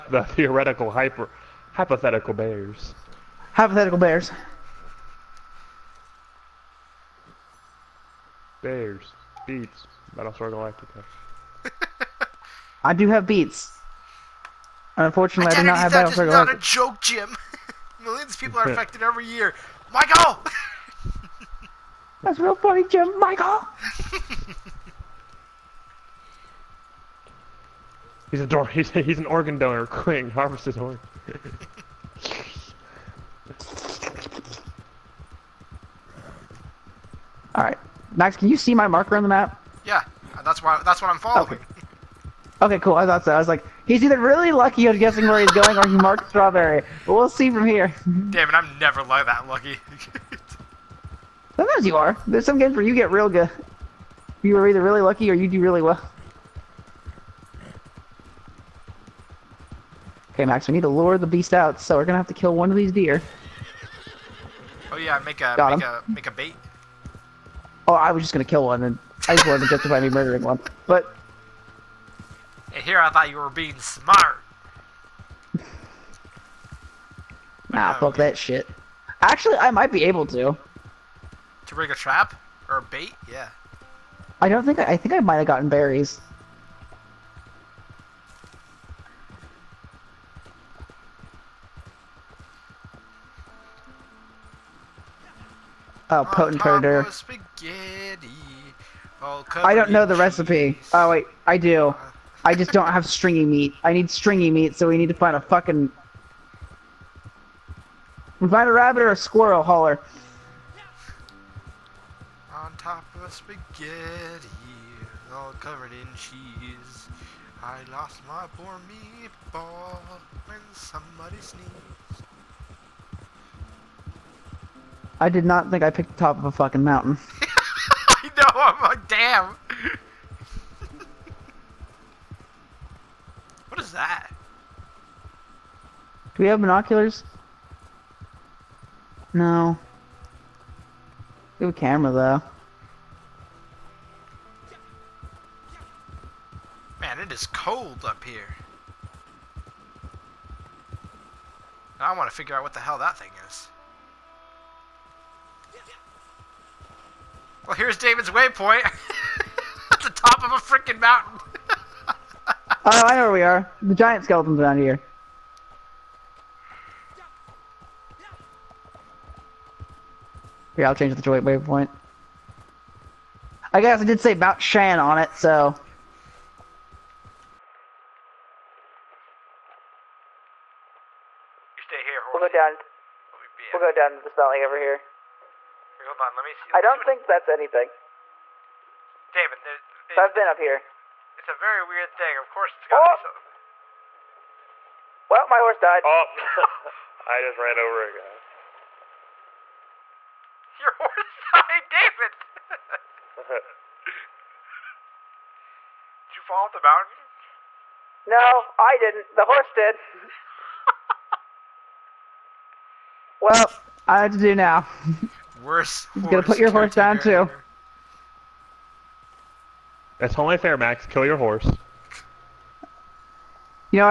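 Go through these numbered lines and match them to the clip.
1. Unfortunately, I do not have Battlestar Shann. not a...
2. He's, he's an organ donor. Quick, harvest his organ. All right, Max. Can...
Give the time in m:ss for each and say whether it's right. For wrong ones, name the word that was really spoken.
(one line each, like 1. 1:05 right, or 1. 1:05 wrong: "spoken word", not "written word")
1. 0:14 wrong: "Galactica", not "Shann"
2. 0:28 right.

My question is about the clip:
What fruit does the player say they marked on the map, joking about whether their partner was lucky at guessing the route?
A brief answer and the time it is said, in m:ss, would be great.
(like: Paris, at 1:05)
strawberry, at 0:46.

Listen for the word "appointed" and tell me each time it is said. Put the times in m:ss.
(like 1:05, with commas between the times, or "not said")
not said.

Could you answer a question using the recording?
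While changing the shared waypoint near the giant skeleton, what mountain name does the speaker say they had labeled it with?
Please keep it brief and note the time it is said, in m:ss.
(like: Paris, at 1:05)
Mount Shann, at 2:54.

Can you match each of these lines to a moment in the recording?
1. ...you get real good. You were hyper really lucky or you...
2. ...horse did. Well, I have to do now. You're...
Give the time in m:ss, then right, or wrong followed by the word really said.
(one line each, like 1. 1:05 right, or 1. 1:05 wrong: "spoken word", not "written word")
1. 0:52 wrong: "either", not "hyper"
2. 3:29 right.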